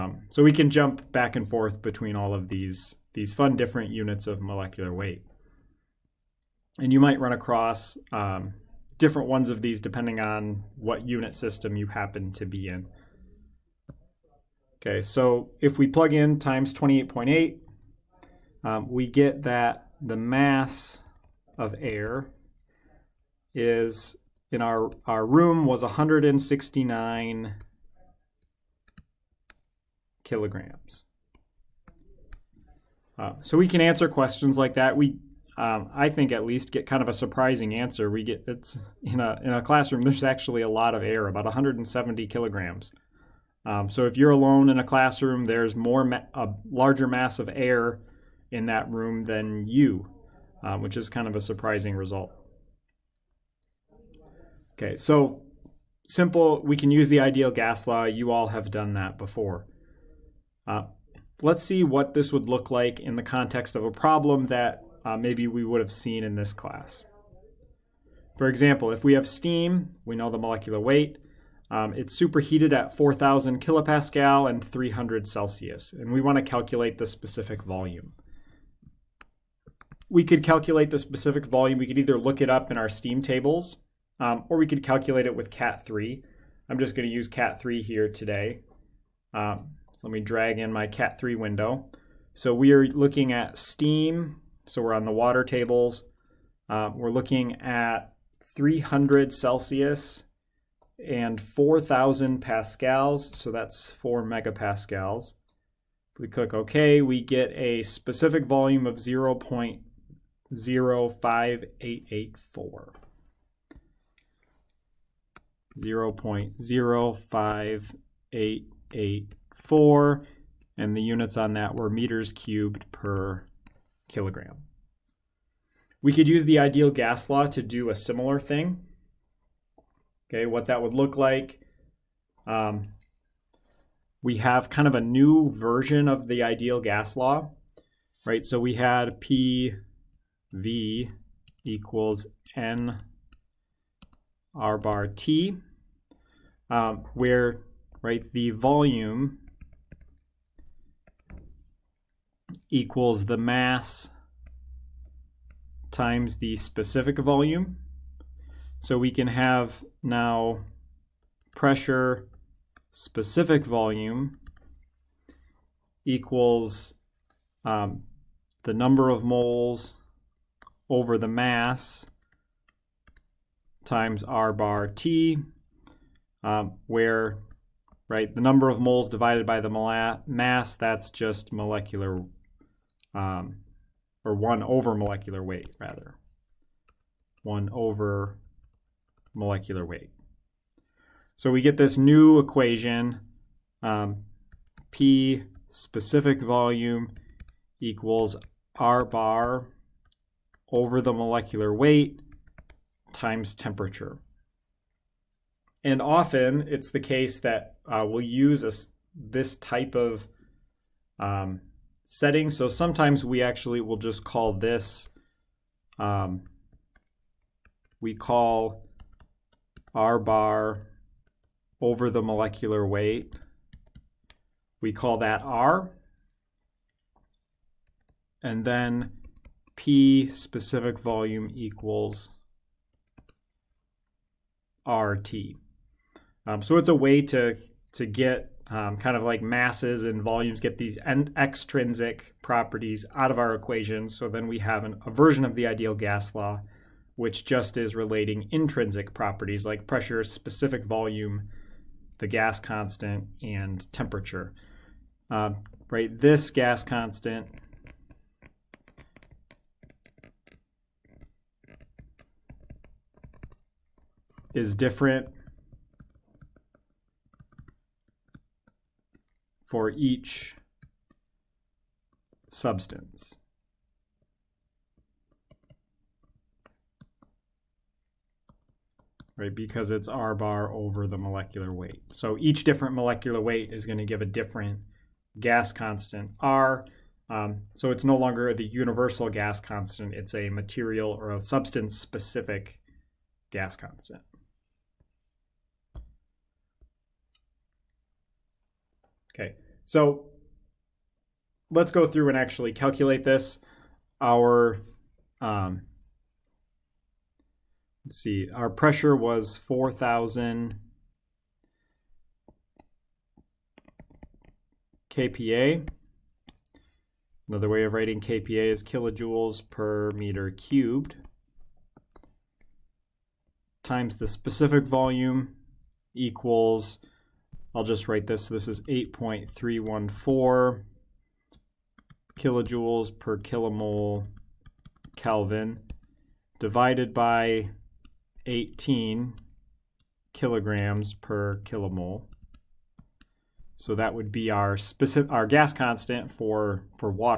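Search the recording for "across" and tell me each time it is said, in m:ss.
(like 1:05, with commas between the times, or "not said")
0:07.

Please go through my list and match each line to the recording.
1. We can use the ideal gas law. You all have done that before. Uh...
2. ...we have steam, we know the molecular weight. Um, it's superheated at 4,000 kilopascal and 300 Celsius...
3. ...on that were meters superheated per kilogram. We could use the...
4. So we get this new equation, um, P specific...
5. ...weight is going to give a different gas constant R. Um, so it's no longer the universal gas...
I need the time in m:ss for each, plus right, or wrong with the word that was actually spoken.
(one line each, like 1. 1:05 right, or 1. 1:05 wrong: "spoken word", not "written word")
1. 0:56 right
2. 1:09 right
3. 2:01 wrong: "cubed", not "superheated"
4. 3:11 right
5. 4:43 right.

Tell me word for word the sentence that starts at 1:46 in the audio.
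If we click OK, we get a specific volume of 0 0.05884.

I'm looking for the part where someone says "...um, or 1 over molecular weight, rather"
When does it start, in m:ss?
3:03.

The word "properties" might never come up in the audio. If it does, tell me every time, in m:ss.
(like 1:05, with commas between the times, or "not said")
4:02, 4:09.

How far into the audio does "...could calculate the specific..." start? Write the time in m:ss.
1:20.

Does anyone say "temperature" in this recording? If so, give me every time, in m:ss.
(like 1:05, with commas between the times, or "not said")
3:23, 4:13.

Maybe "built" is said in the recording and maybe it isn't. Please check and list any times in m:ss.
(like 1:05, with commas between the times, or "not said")
not said.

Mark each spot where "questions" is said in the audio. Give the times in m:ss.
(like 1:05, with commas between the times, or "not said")
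0:34.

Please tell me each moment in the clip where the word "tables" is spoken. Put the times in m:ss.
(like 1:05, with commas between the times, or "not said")
1:23, 1:35.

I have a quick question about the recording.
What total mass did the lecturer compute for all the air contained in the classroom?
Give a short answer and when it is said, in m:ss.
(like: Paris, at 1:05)
169 kilograms, at 0:25.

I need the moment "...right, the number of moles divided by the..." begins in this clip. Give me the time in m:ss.
2:58.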